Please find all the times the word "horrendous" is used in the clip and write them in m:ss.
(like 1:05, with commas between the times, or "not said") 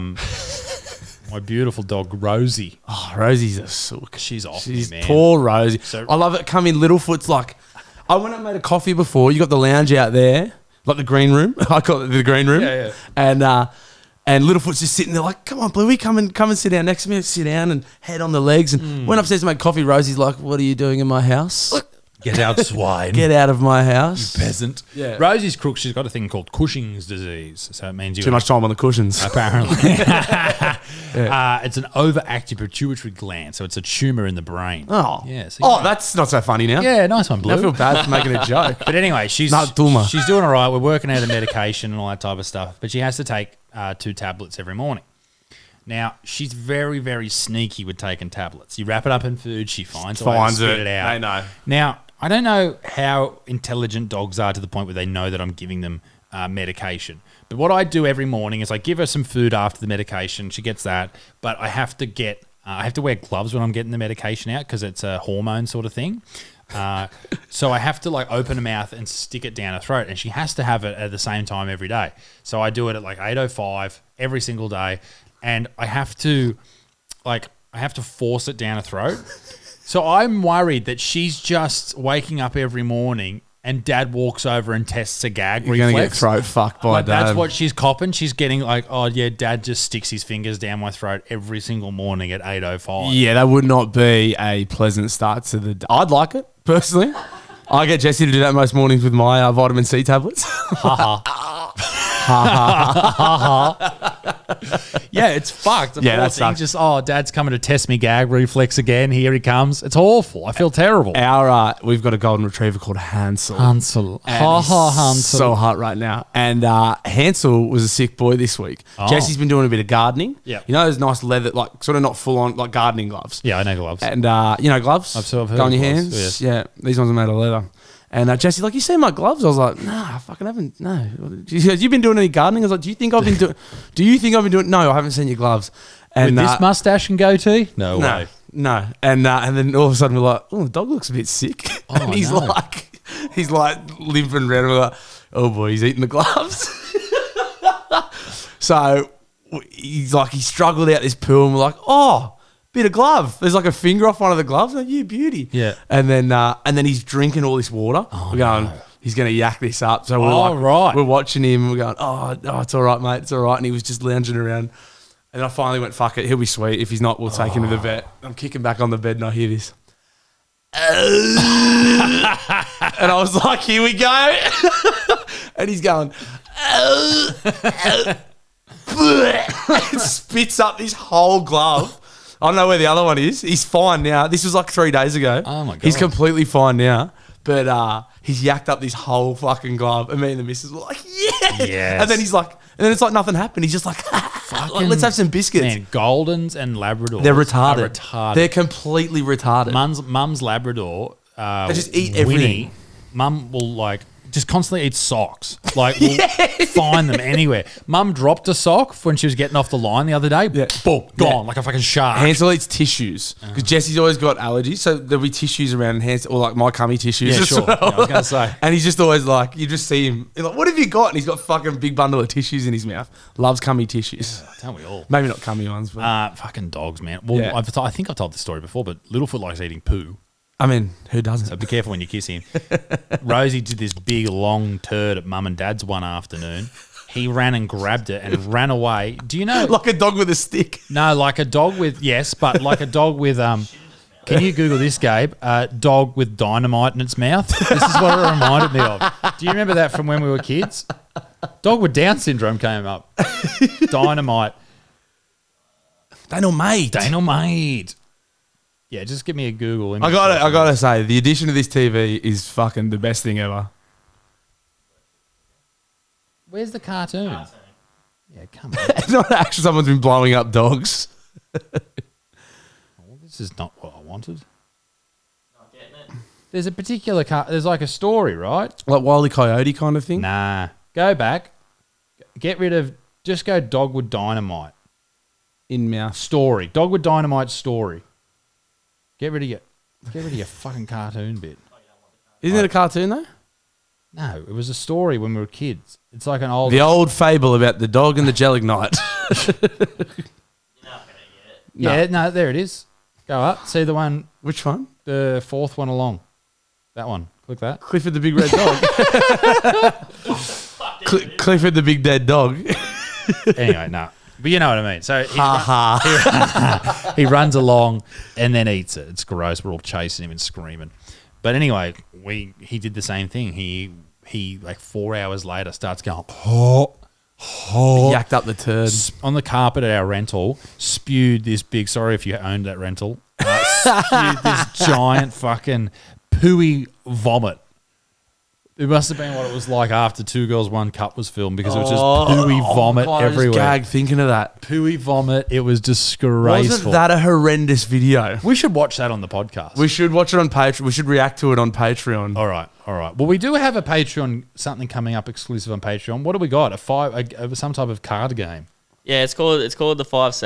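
5:47.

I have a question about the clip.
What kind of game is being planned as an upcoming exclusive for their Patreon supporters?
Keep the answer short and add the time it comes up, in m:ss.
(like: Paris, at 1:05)
Card game, at 5:58.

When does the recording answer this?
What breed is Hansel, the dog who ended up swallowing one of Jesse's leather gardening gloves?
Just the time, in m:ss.
1:52.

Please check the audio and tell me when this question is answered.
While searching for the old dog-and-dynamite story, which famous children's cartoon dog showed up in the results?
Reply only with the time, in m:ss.
5:07.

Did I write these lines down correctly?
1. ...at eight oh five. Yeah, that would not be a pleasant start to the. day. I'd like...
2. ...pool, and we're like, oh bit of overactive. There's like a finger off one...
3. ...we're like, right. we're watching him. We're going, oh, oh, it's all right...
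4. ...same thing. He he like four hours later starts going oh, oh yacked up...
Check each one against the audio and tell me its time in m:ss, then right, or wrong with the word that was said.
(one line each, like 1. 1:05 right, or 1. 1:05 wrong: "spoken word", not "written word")
1. 1:32 right
2. 2:31 wrong: "glove", not "overactive"
3. 2:40 right
4. 5:23 right.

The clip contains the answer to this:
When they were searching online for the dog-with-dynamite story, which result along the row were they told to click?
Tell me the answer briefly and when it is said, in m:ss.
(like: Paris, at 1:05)
The fourth one, at 5:05.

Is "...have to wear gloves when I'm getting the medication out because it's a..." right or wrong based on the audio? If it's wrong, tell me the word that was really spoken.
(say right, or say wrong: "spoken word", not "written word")
right.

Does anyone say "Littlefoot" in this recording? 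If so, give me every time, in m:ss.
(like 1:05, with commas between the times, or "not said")
0:06, 0:14, 3:49.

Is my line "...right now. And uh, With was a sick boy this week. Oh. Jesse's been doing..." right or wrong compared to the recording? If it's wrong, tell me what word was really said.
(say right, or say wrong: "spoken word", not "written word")
wrong: "Hansel", not "With".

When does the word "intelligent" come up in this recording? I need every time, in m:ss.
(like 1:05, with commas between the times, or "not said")
0:53.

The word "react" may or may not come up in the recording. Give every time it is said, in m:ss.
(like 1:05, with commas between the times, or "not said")
5:51.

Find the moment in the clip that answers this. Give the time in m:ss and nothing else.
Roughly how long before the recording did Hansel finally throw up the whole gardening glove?
3:04.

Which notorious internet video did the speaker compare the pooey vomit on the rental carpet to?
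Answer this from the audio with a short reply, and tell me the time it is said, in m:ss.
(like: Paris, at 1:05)
Two Girls One Cup, at 5:40.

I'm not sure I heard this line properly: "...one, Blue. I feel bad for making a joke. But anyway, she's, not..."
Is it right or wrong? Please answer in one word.
right.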